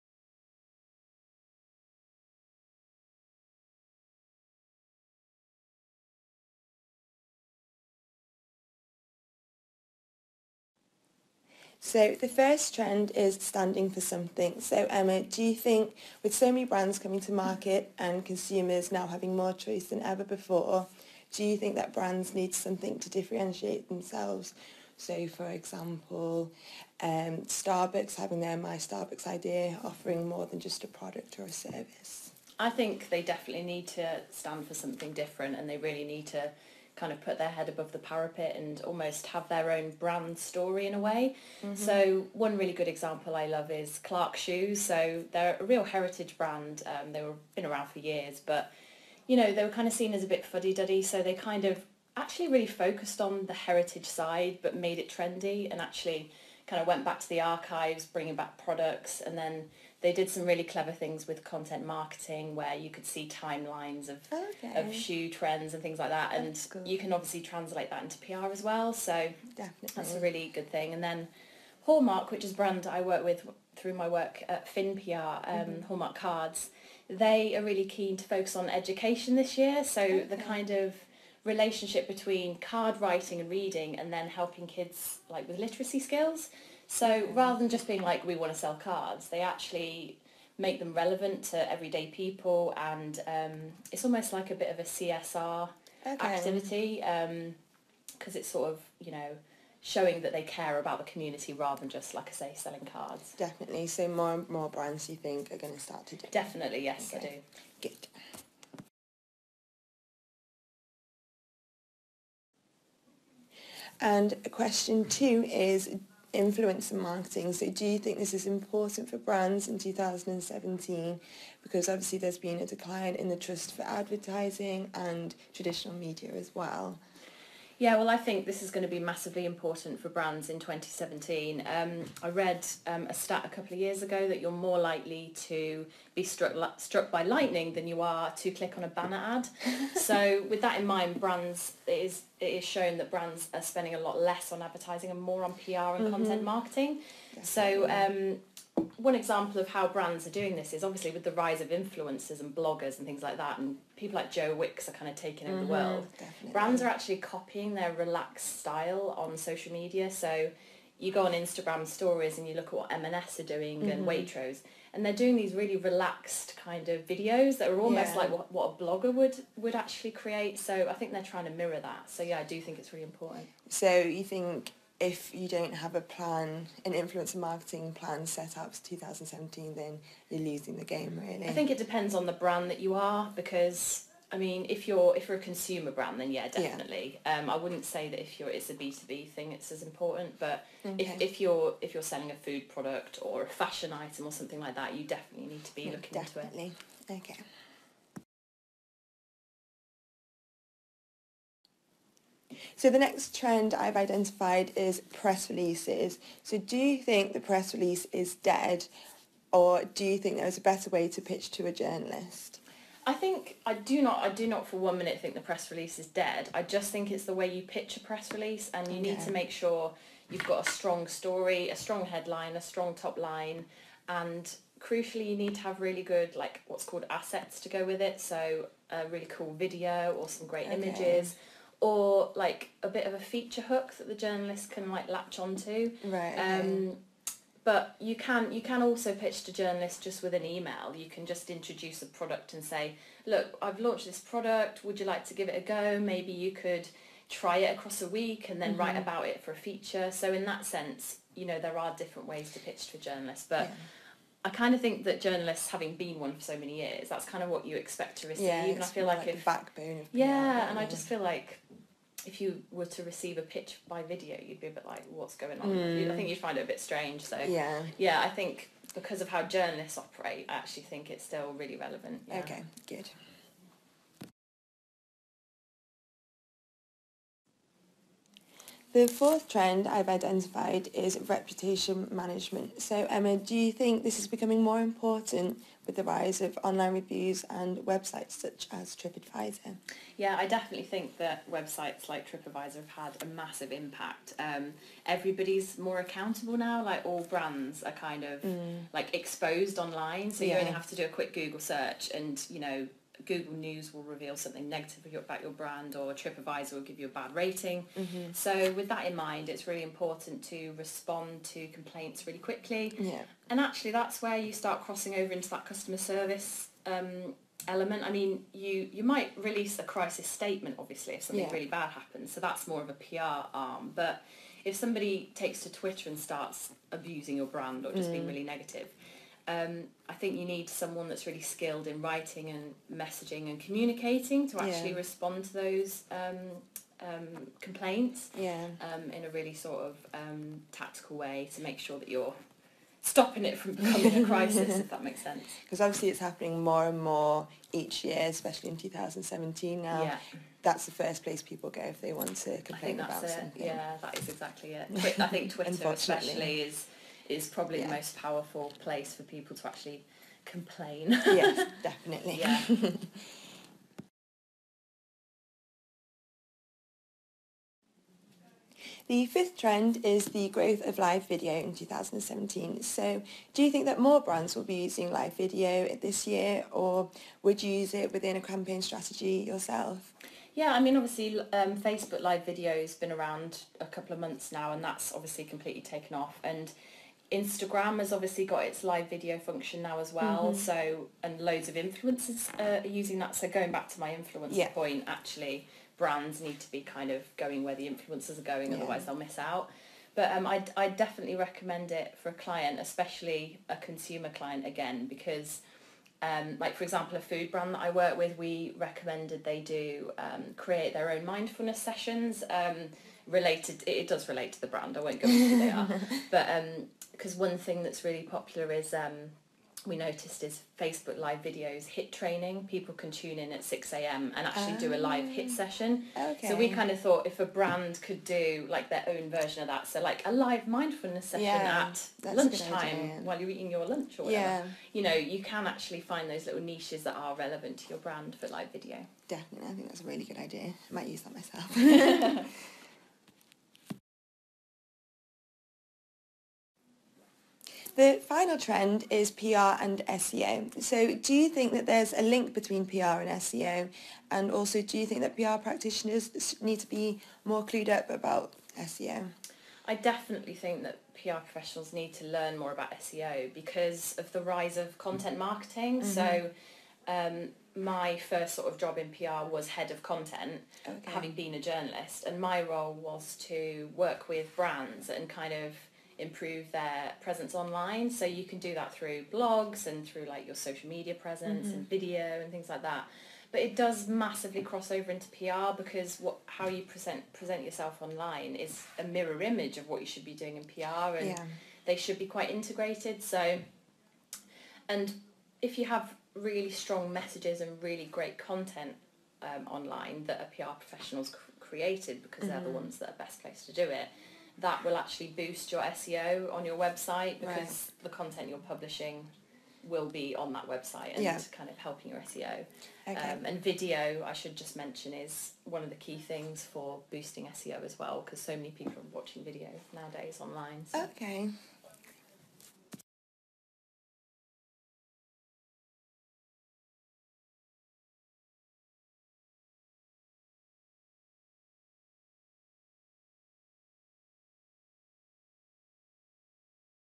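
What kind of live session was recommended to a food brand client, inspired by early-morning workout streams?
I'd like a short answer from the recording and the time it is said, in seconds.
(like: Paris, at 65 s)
mindfulness session, at 430 s.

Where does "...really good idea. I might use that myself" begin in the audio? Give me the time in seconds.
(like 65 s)
440 s.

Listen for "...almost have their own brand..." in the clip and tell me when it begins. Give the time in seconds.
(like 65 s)
38 s.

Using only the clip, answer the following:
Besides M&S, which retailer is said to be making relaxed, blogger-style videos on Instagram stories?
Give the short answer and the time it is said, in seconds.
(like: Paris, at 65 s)
Waitrose, at 164 s.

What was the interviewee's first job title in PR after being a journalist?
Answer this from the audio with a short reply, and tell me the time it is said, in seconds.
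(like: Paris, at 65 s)
head of content, at 469 s.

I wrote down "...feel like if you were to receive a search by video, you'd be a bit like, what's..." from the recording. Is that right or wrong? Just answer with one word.
wrong.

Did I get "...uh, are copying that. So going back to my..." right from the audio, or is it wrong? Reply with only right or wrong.
wrong.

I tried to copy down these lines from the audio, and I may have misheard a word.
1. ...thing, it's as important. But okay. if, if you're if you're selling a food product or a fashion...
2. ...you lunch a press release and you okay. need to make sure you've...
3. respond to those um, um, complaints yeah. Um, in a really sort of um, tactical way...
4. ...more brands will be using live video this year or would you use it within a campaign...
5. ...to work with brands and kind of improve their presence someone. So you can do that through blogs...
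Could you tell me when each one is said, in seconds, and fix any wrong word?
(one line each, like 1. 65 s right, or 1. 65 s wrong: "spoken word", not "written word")
1. 189 s right
2. 217 s wrong: "pitch", not "lunch"
3. 334 s right
4. 373 s right
5. 473 s wrong: "online", not "someone".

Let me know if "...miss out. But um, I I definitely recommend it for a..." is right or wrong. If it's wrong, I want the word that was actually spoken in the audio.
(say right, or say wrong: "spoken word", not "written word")
right.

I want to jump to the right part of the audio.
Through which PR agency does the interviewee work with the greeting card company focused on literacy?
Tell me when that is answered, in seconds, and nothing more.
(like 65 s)
74 s.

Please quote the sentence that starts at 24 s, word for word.
So for example, um, Starbucks having their My Starbucks idea, offering more than just a product or a service.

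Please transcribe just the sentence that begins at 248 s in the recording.
write about it for a feature.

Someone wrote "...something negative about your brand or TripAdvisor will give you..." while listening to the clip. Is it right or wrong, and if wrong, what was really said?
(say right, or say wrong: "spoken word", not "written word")
right.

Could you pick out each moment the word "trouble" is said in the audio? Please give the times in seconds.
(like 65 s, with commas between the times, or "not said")
not said.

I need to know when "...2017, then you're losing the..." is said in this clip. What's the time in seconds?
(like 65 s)
178 s.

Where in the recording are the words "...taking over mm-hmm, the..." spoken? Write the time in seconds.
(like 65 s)
155 s.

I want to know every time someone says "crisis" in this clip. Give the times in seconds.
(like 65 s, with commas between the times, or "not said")
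319 s, 344 s.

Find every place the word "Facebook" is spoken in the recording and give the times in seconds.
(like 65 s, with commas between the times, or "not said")
381 s, 420 s.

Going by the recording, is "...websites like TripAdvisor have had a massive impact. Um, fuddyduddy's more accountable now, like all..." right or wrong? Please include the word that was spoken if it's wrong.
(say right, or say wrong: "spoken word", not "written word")
wrong: "everybody", not "fuddyduddy".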